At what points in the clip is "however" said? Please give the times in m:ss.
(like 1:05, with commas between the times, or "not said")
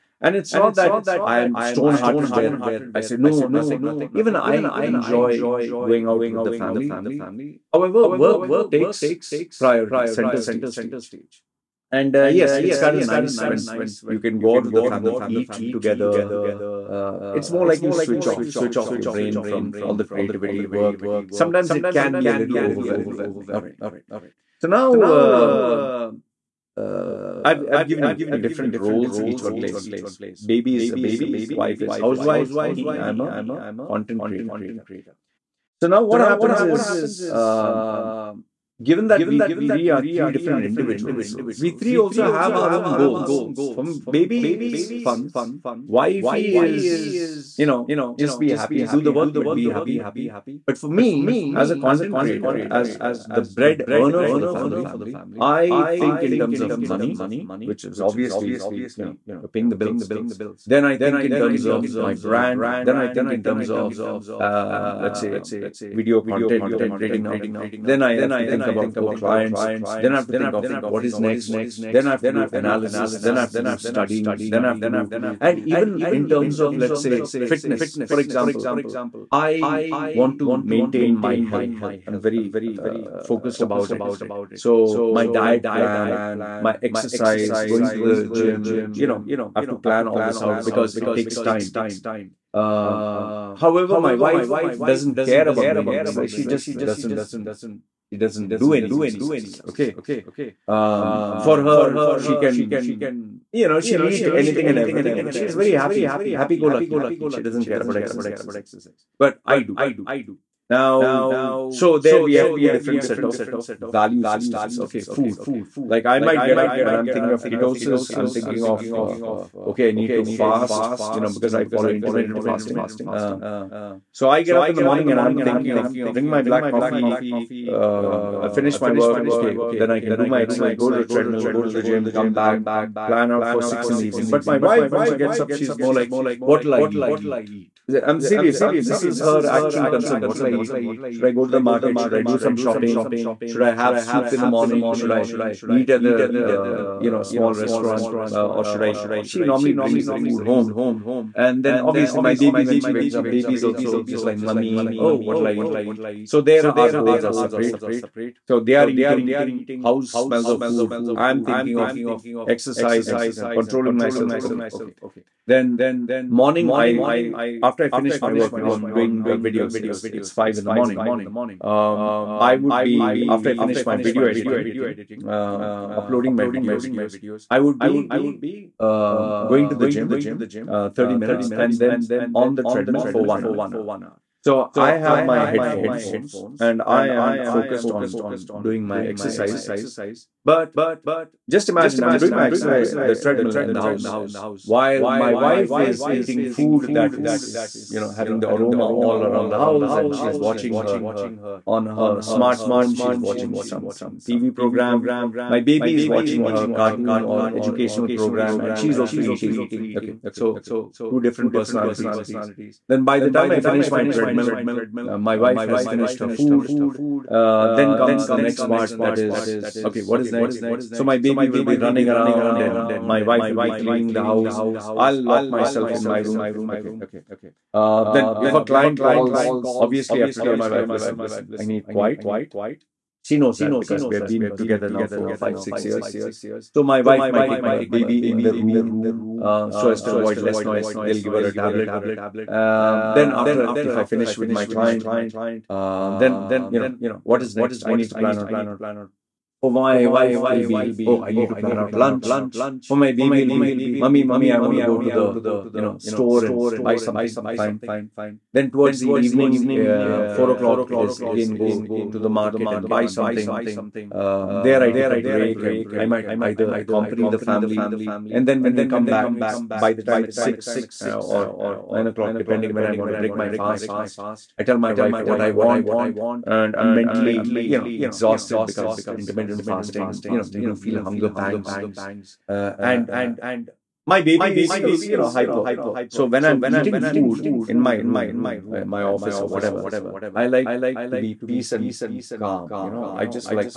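0:07, 1:33.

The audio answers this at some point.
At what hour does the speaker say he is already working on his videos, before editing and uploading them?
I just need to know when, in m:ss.
2:50.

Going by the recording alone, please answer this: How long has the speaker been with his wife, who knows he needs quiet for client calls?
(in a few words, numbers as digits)
5 or 6 years.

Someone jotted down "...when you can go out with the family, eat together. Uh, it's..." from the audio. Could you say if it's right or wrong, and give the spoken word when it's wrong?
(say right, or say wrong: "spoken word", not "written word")
right.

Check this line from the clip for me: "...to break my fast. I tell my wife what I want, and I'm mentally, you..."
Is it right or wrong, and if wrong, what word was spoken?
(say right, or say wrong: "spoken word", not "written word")
right.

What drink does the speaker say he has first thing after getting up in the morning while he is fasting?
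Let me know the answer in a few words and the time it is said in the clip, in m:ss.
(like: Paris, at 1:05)
black coffee, at 2:06.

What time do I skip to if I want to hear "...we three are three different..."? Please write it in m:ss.
0:39.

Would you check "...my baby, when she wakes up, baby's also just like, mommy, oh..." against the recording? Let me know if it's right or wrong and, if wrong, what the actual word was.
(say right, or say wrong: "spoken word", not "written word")
right.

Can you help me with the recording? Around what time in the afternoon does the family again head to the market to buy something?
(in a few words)
4 o'clock.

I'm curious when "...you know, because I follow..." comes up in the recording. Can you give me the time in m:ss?
2:01.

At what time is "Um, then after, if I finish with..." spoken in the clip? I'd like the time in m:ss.
4:02.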